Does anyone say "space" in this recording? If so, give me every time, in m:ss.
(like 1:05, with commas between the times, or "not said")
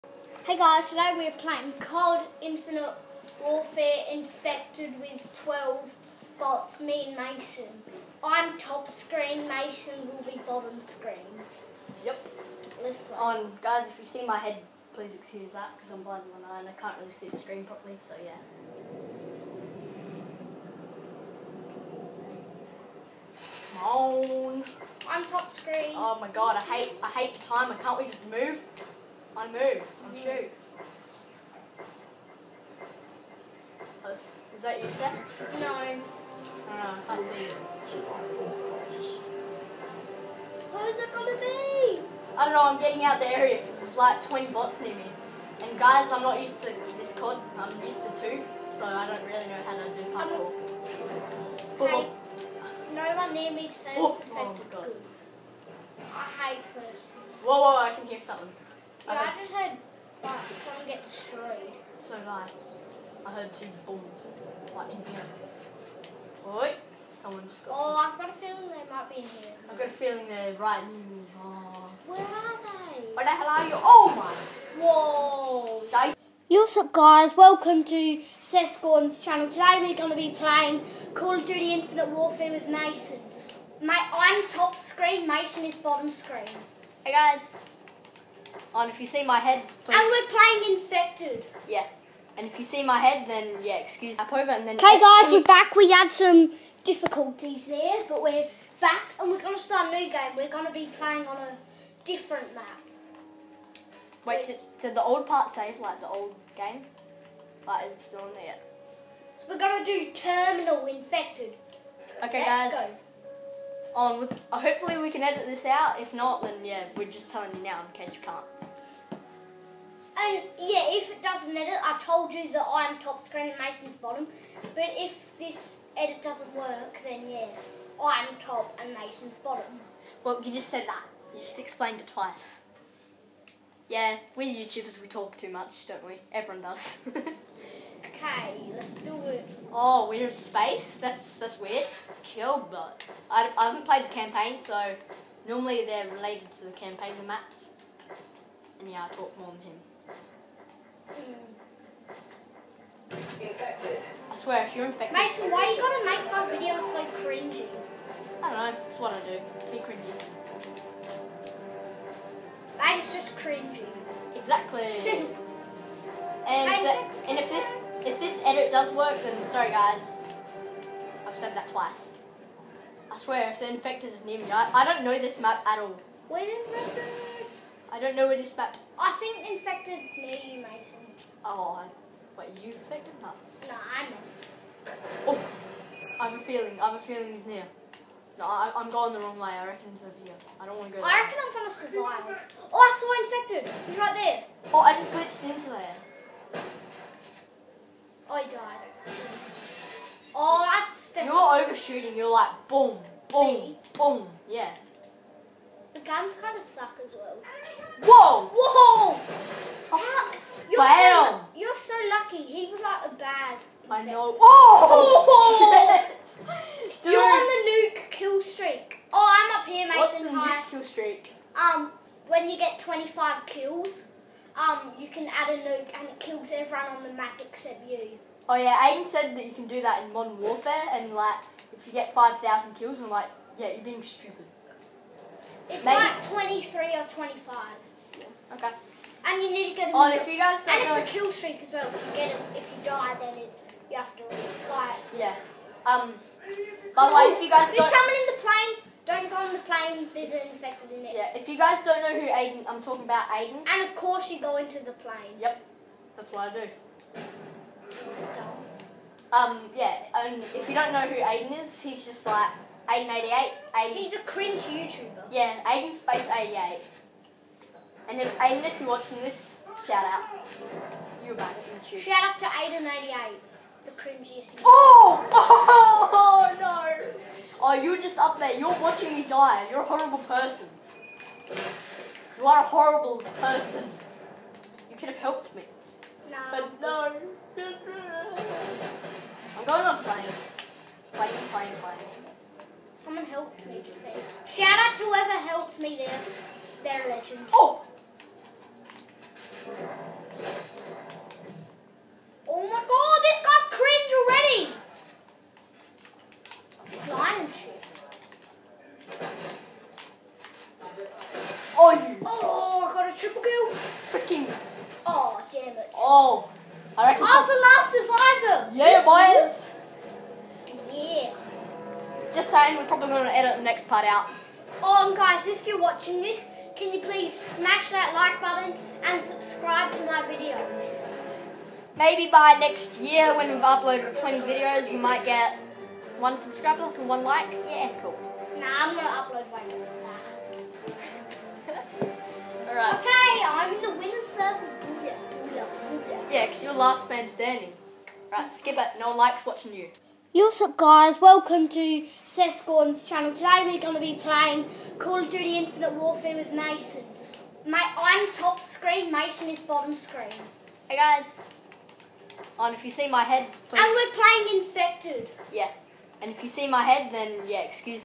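2:20, 4:25.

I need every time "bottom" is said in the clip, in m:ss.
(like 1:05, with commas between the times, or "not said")
0:10, 1:25, 2:03, 2:09, 5:59.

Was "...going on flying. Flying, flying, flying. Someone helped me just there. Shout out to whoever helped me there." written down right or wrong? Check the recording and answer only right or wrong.
right.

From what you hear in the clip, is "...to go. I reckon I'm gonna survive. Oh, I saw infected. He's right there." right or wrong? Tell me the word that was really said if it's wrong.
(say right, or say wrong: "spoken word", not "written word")
right.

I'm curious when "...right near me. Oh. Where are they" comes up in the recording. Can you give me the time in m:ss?
1:10.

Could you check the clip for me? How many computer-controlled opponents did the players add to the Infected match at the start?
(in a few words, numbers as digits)
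12.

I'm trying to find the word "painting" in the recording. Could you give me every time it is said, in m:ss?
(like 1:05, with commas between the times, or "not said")
not said.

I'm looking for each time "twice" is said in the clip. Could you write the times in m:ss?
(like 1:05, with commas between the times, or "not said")
2:12, 2:51.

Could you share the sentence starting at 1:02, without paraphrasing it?
So like, I heard two bombs like in here.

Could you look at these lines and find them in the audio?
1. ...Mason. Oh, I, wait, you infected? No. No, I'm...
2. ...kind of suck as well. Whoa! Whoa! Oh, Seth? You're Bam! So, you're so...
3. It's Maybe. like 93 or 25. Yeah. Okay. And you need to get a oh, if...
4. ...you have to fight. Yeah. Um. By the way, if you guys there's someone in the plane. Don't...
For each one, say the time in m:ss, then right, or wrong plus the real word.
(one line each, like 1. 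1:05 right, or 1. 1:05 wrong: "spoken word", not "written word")
1. 3:00 right
2. 3:26 wrong: "How", not "Seth"
3. 3:55 wrong: "23", not "93"
4. 4:03 right.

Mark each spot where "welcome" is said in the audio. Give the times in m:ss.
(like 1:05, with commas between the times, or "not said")
1:17, 5:51.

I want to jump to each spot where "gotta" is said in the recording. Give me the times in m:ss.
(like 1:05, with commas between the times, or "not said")
2:35.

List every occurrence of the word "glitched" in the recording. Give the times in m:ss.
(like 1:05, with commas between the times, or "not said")
3:15.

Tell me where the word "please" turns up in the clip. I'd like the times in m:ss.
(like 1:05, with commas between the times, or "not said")
0:14, 1:29, 5:27, 6:03.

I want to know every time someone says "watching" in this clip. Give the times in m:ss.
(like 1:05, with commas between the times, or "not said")
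4:28, 4:38, 5:25, 5:49.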